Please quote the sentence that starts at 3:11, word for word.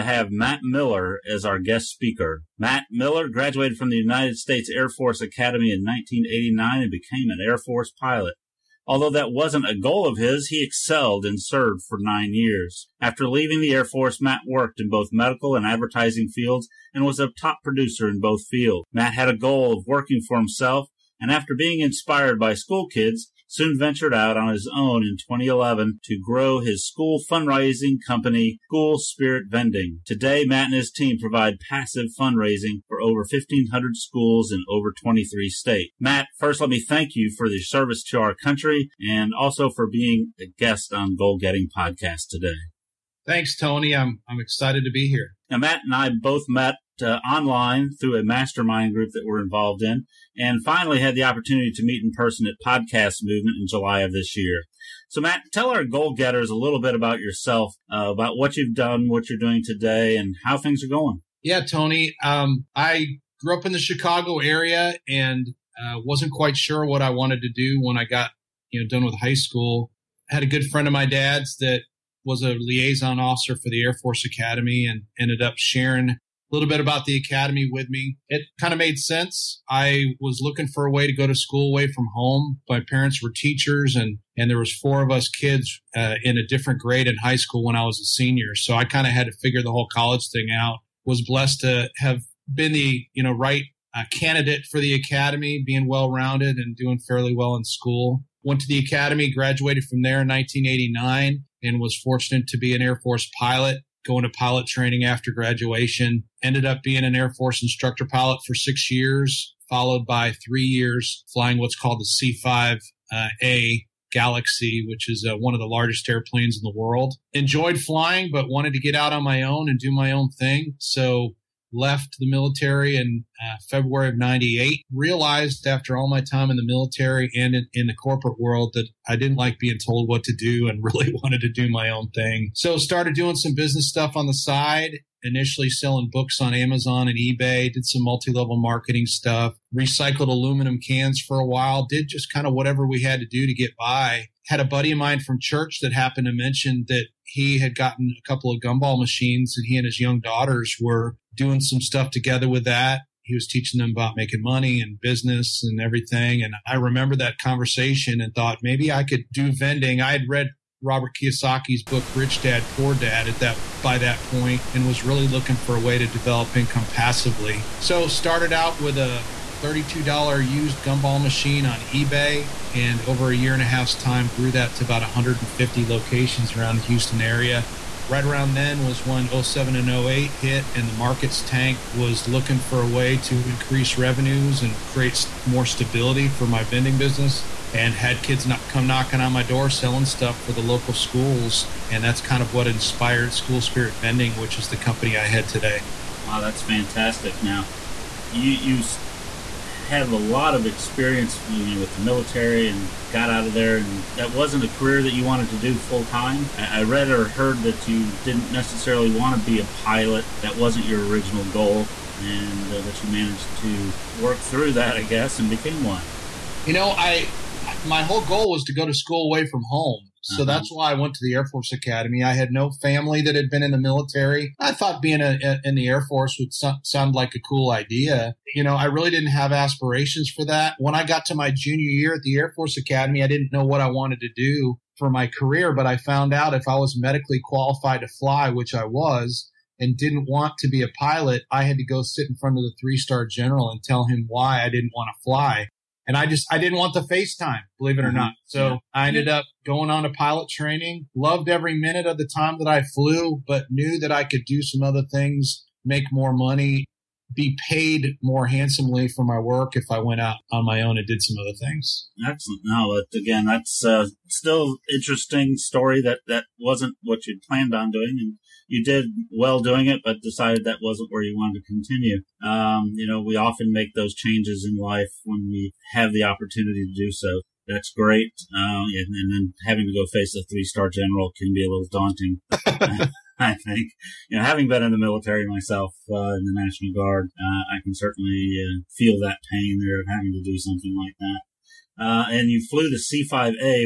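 And that's kind of what inspired School Spirit Vending, which is the company I head today.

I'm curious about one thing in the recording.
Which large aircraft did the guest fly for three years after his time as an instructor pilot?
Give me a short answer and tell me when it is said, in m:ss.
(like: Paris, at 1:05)
C5A Galaxy, at 1:52.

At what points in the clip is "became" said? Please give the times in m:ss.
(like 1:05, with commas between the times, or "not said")
0:06, 3:35.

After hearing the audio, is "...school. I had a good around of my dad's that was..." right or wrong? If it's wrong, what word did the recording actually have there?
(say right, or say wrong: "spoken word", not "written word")
wrong: "friend", not "around".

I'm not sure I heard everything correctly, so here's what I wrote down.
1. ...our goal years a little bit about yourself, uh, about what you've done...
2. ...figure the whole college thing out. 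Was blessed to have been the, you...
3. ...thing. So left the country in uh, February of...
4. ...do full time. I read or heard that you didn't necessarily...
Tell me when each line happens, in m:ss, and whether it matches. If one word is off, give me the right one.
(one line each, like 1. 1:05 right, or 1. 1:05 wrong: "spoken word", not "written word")
1. 0:55 wrong: "getters", not "years"
2. 1:29 right
3. 2:00 wrong: "military", not "country"
4. 3:25 right.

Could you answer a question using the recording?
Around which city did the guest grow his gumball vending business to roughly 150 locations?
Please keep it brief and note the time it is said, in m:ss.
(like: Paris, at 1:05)
Houston, at 2:56.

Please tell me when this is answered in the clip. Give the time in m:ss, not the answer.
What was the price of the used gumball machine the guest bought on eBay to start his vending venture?
2:49.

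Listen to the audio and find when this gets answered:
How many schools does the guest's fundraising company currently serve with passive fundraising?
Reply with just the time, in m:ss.
0:33.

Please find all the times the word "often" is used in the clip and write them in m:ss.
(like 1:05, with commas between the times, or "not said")
4:33.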